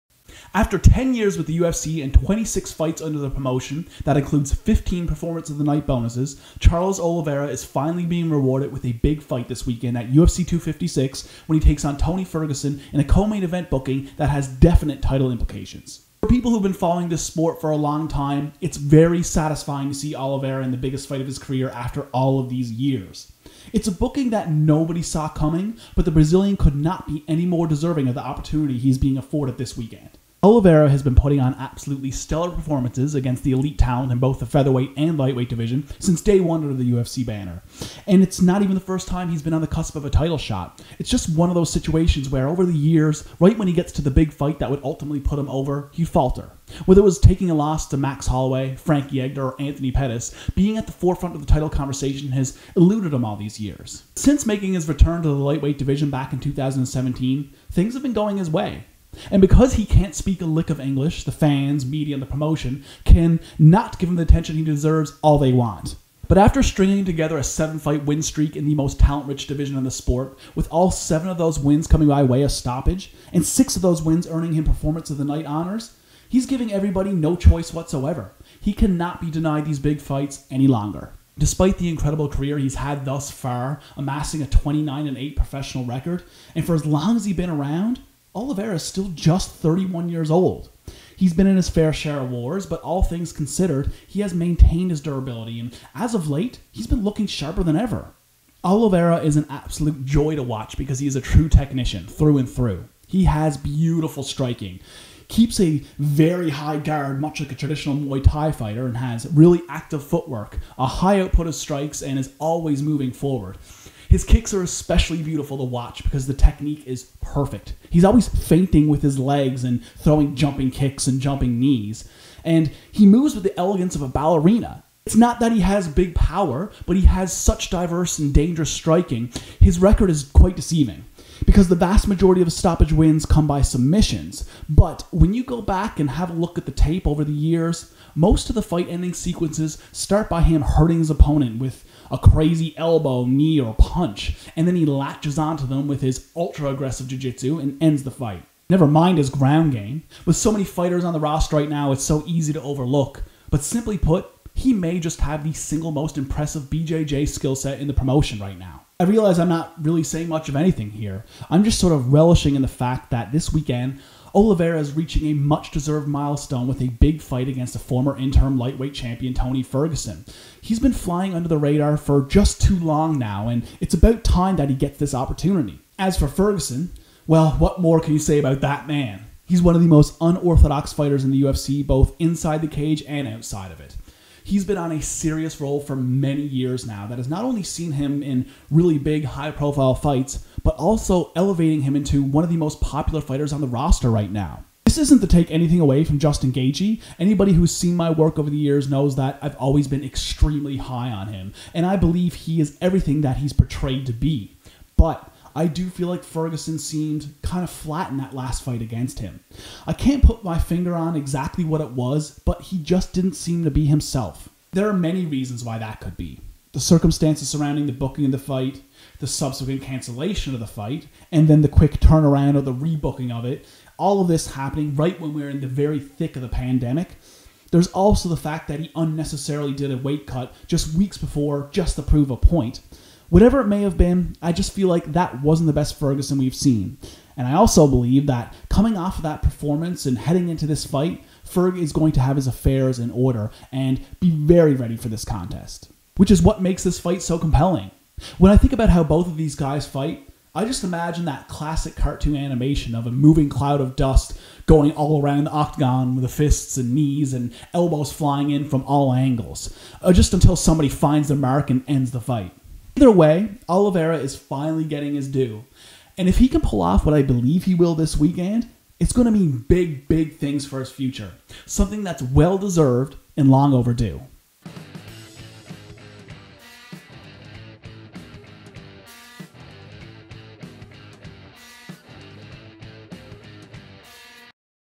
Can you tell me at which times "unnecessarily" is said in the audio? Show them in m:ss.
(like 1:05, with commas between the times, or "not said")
3:48.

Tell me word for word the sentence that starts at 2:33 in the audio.
But simply put, he may just have the single most impressive BJJ skill set in the promotion right now.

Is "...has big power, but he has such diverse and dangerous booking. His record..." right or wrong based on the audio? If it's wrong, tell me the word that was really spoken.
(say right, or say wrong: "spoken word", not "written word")
wrong: "striking", not "booking".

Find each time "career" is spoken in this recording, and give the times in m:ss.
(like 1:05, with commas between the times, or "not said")
0:21, 1:22.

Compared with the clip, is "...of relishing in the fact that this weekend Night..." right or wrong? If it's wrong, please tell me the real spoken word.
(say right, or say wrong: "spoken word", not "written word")
wrong: "Oliveira", not "Night".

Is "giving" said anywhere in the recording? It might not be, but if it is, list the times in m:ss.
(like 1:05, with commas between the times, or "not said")
1:16.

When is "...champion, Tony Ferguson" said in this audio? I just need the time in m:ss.
2:48.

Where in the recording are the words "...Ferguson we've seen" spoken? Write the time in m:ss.
3:55.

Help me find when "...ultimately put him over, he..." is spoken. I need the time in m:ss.
0:44.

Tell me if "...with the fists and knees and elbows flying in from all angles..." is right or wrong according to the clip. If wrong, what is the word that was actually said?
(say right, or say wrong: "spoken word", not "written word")
right.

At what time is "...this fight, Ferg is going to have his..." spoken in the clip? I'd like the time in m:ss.
4:00.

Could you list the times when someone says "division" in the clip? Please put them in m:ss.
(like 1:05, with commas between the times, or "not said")
0:35, 0:55, 1:09.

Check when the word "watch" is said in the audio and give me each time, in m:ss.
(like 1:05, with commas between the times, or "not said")
1:40, 1:55.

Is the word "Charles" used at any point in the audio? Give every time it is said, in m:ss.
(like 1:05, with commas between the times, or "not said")
0:06.